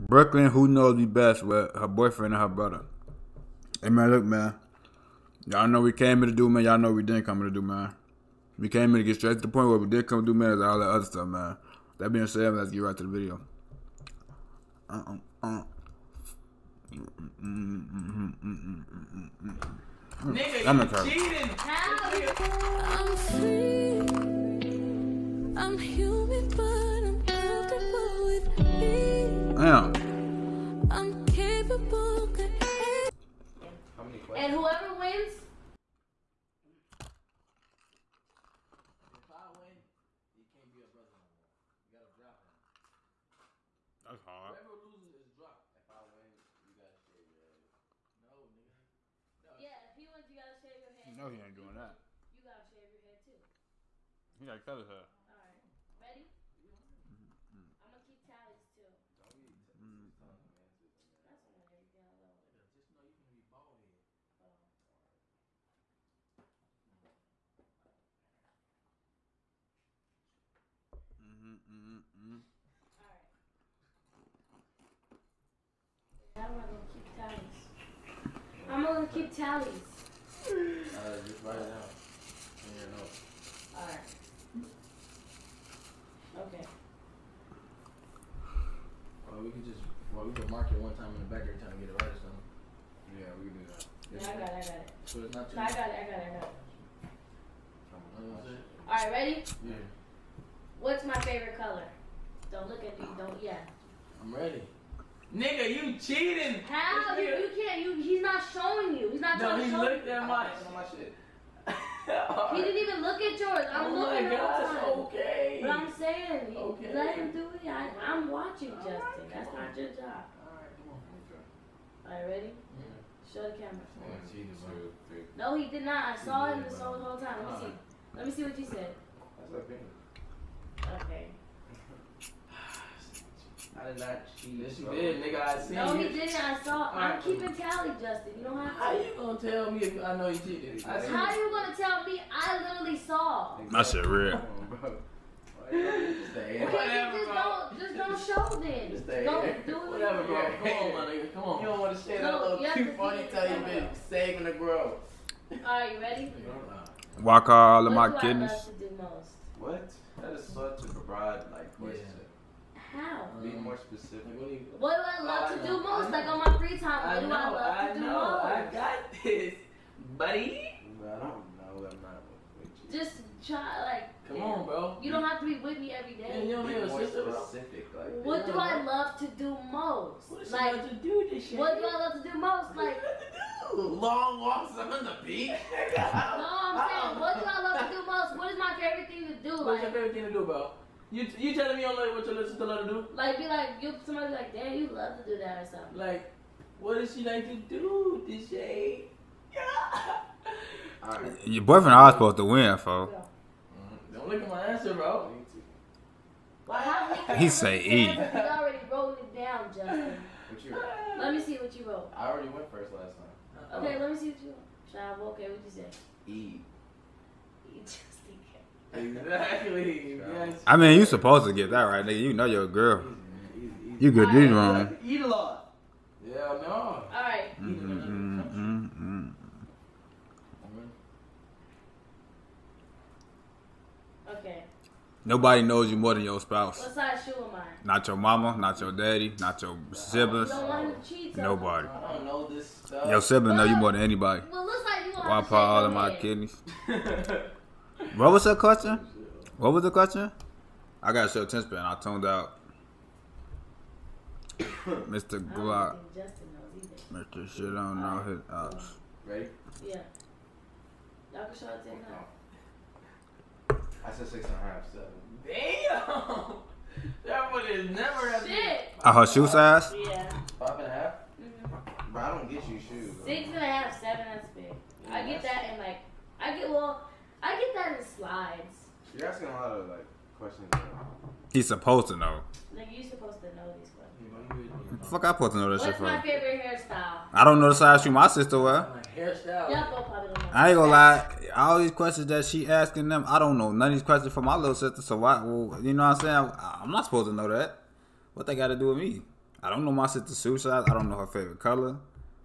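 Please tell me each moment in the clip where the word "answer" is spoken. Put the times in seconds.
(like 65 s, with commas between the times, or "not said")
204 s.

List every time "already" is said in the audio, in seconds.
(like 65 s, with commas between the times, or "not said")
208 s, 212 s.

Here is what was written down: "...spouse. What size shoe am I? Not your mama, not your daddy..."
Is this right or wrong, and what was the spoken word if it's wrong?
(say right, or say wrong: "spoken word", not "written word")
right.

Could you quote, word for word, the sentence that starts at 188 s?
What is my favorite thing to do?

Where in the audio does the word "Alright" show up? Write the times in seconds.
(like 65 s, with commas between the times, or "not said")
55 s, 122 s, 155 s.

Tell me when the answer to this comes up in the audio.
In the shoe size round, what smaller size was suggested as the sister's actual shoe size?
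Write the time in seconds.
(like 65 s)
270 s.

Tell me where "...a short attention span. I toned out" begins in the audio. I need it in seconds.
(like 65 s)
251 s.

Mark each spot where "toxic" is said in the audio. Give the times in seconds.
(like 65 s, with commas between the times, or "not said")
not said.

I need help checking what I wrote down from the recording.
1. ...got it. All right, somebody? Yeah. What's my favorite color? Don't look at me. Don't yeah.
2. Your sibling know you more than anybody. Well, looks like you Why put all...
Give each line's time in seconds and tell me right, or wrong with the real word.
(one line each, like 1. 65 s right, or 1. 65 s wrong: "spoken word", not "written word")
1. 96 s wrong: "ready", not "somebody"
2. 243 s right.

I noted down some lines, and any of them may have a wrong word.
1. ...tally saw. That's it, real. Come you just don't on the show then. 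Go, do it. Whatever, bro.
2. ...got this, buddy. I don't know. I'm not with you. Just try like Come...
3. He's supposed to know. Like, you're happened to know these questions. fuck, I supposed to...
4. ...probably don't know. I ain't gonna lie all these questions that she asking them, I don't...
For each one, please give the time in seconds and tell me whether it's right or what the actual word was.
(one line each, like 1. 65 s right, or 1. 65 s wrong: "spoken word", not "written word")
1. 142 s wrong: "literally", not "tally"
2. 168 s right
3. 281 s wrong: "supposed", not "happened"
4. 290 s right.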